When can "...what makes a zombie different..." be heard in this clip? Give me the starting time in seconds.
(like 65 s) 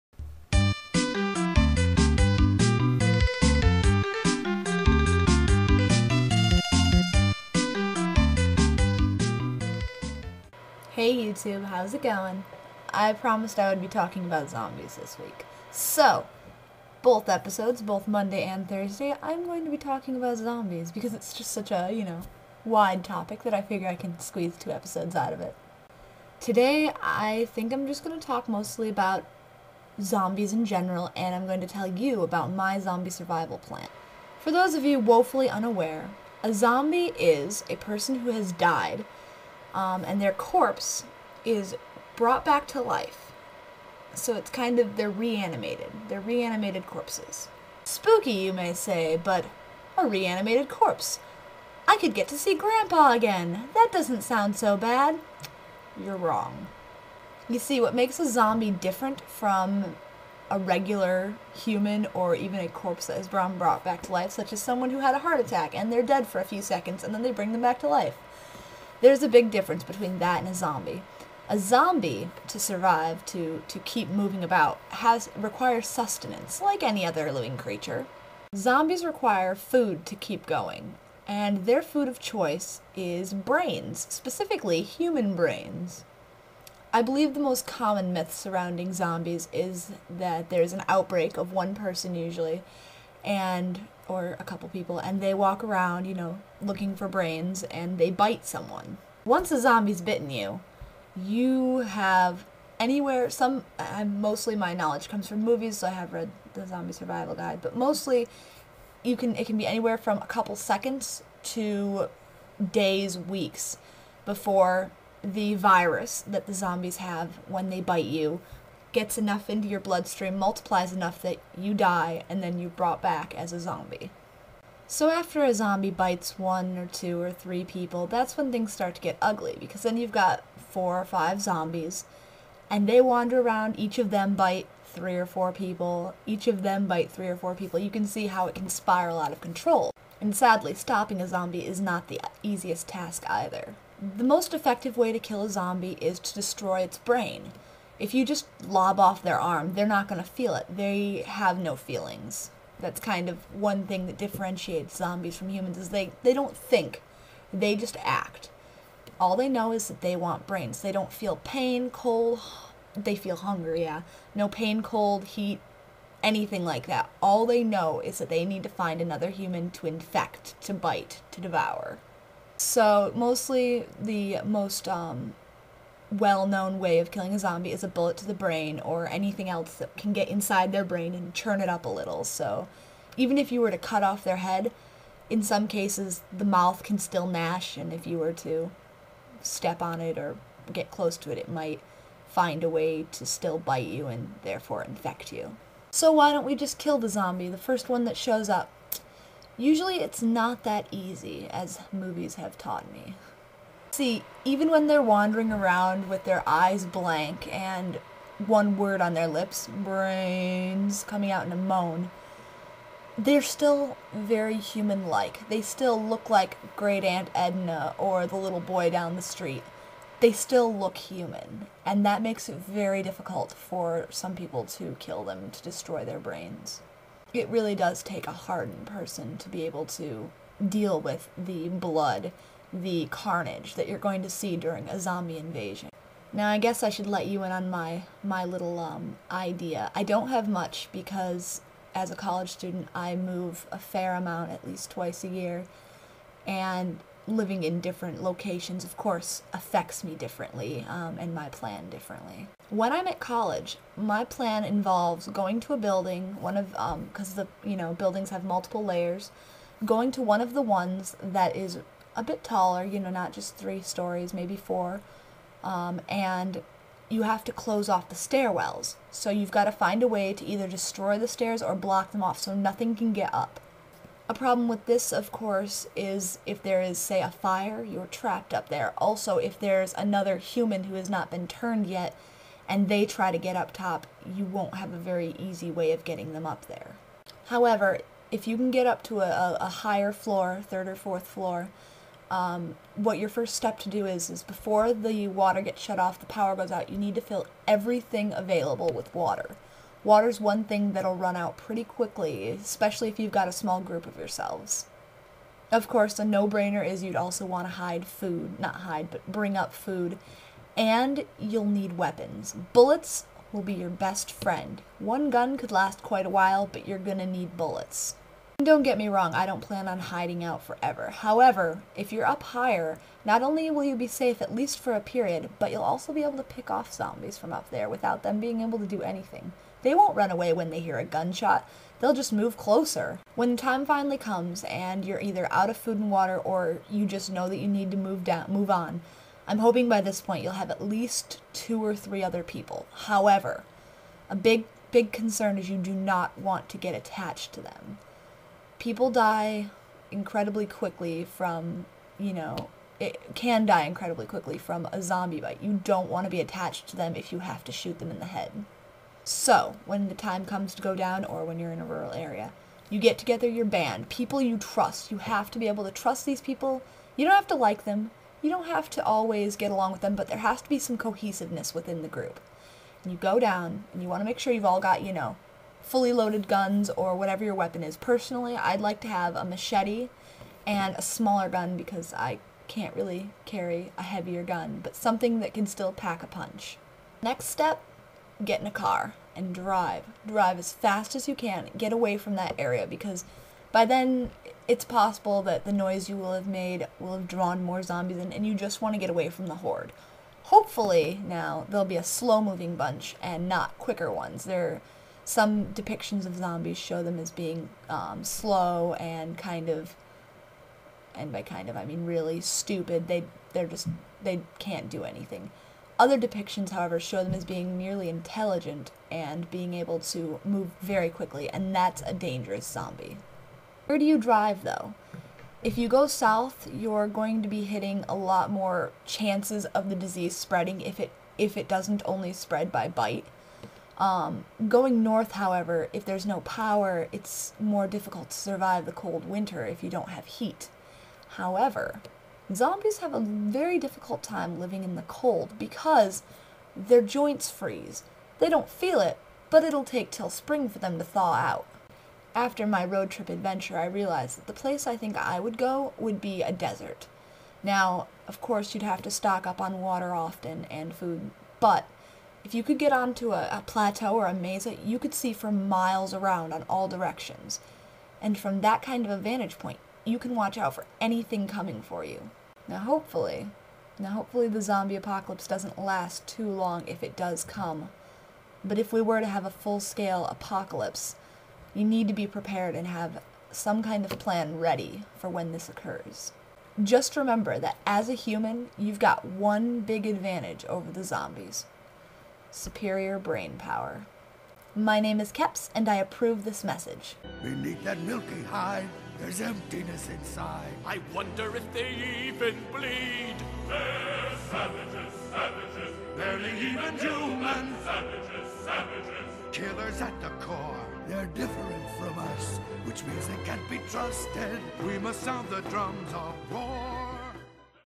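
57 s.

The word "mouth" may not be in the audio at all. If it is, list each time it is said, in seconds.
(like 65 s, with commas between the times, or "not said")
186 s.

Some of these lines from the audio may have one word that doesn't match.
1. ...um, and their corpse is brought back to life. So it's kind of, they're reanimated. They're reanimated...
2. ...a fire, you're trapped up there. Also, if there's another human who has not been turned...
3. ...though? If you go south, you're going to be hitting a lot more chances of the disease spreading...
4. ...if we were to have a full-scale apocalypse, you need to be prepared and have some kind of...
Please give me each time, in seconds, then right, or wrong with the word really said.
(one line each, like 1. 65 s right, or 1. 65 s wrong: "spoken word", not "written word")
1. 39 s right
2. 277 s right
3. 424 s right
4. 478 s right.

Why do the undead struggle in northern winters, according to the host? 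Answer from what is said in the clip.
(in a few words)
their joints freeze.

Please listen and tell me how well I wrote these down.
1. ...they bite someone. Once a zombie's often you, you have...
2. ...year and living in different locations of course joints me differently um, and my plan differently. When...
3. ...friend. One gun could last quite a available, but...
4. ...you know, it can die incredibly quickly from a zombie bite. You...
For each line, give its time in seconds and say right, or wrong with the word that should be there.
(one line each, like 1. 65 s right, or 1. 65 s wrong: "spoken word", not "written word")
1. 97 s wrong: "bitten", not "often"
2. 245 s wrong: "affects", not "joints"
3. 314 s wrong: "while", not "available"
4. 352 s right.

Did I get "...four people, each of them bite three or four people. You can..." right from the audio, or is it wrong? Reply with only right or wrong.
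right.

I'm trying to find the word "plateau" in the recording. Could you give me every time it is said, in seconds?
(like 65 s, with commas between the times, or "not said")
463 s.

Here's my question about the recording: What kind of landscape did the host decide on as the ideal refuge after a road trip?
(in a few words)
desert.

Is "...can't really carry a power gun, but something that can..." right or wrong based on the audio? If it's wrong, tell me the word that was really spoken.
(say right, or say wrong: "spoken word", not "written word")
wrong: "heavier", not "power".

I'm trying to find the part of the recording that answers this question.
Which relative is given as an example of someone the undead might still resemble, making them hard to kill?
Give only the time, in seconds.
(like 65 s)
216 s.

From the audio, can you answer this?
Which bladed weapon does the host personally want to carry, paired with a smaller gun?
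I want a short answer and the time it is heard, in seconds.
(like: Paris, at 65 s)
machete, at 379 s.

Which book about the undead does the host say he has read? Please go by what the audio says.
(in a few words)
The Zombie Survival Guide.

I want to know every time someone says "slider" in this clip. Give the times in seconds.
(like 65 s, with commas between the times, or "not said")
not said.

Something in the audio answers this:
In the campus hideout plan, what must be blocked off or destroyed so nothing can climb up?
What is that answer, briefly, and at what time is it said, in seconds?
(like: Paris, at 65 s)
the stairwells, at 268 s.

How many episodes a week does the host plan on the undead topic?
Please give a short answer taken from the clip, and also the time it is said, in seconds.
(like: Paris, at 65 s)
2, at 24 s.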